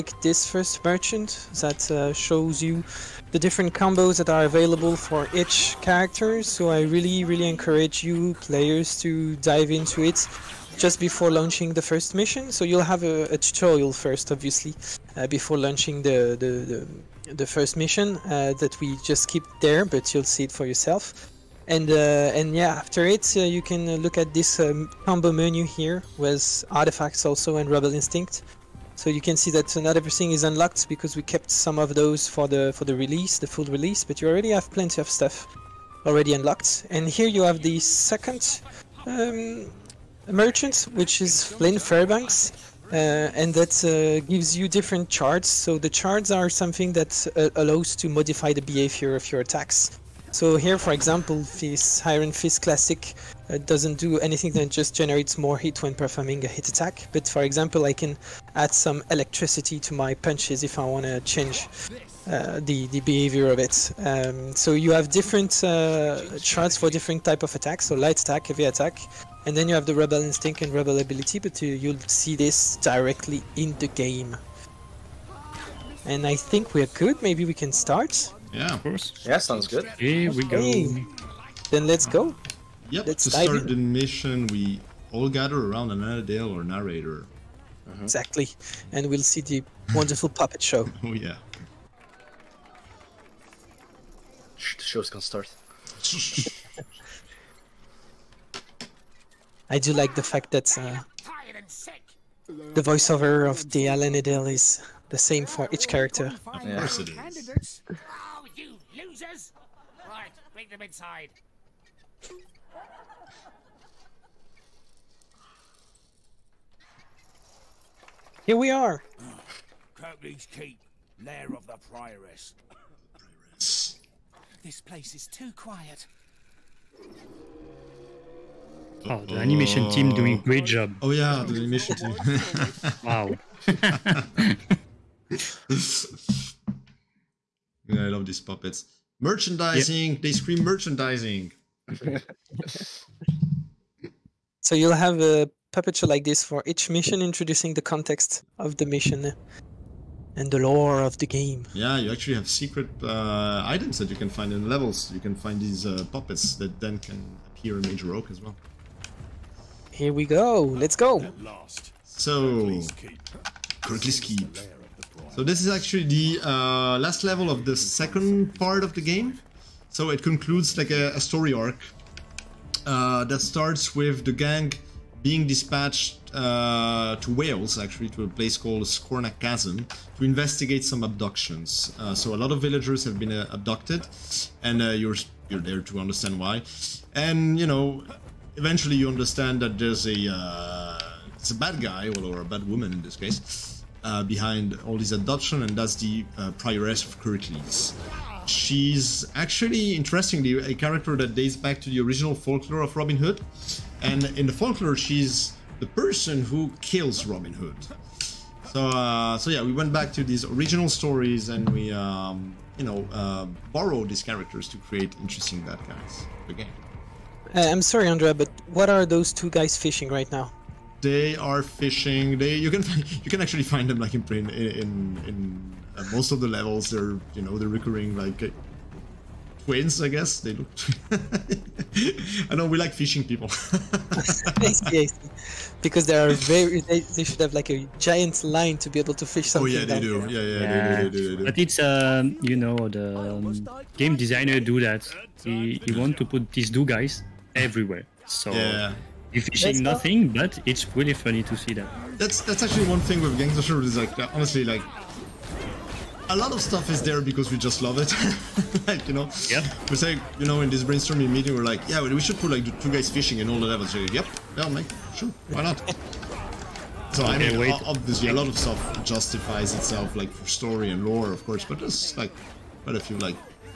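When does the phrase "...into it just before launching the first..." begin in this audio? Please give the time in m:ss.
0:09.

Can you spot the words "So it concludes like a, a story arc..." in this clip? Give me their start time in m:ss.
2:49.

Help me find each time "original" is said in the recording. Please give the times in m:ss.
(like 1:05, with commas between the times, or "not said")
3:21, 3:30.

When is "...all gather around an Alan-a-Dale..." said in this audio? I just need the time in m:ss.
1:25.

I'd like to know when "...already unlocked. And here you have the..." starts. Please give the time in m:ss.
0:36.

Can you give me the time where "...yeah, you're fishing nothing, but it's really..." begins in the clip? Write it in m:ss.
4:08.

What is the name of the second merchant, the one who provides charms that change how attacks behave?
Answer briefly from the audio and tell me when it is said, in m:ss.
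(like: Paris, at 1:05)
Flynn Fairbanks, at 0:41.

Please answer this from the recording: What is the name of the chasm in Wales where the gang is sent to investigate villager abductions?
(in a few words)
Scorna Chasm.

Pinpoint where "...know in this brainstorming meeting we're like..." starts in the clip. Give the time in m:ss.
4:20.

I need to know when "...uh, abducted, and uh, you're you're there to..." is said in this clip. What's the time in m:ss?
3:03.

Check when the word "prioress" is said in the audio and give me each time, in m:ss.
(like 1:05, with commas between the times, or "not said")
2:01, 3:16.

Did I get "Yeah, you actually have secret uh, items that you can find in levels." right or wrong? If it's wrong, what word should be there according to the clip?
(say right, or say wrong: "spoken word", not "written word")
right.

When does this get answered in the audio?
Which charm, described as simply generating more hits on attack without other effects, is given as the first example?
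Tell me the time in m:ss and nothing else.
0:52.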